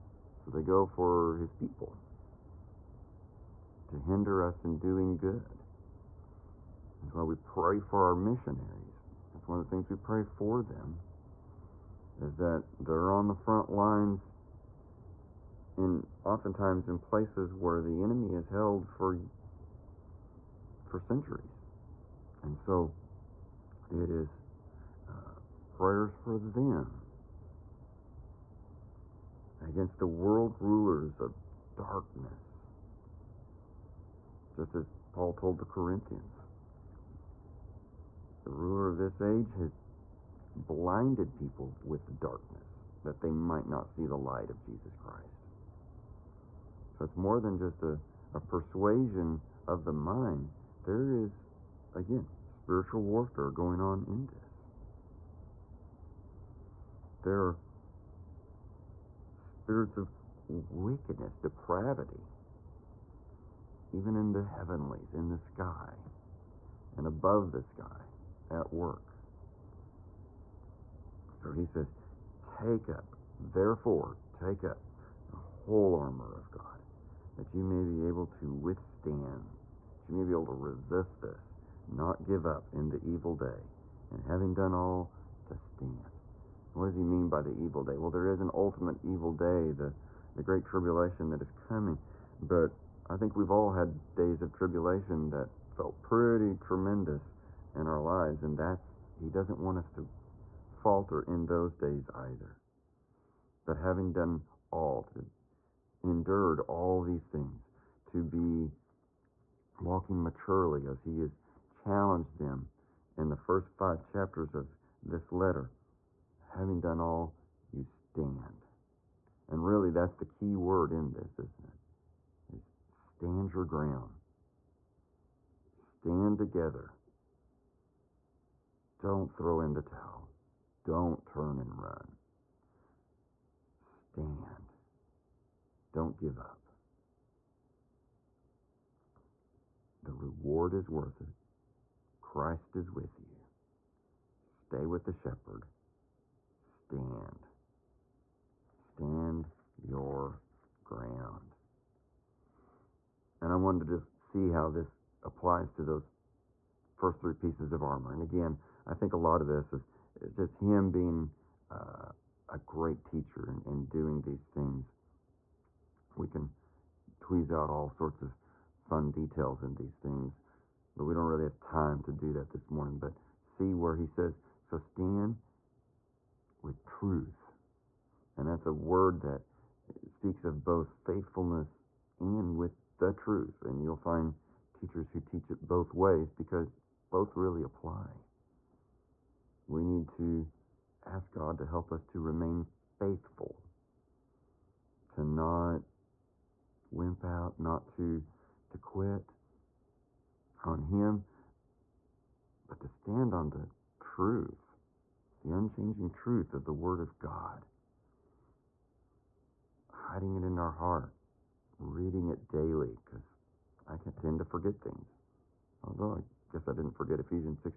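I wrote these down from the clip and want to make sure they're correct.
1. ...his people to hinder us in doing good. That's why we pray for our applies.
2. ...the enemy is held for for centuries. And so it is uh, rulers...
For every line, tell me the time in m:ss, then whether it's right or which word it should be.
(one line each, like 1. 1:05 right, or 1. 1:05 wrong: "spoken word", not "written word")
1. 0:01 wrong: "missionaries", not "applies"
2. 0:17 wrong: "prayers", not "rulers".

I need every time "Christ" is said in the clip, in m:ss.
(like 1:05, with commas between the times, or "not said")
0:44, 2:22.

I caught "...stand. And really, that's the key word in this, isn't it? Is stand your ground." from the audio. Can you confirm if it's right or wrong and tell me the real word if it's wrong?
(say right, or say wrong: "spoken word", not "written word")
right.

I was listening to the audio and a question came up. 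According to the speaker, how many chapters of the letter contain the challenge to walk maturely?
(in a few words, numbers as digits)
5.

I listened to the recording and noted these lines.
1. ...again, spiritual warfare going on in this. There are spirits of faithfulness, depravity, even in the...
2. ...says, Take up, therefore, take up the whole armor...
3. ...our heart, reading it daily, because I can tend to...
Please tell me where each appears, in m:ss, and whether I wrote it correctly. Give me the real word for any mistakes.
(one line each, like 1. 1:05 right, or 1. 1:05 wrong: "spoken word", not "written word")
1. 0:51 wrong: "wickedness", not "faithfulness"
2. 1:11 right
3. 3:30 right.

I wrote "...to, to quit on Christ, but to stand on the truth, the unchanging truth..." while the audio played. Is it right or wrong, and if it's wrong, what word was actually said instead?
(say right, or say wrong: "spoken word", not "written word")
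wrong: "Him", not "Christ".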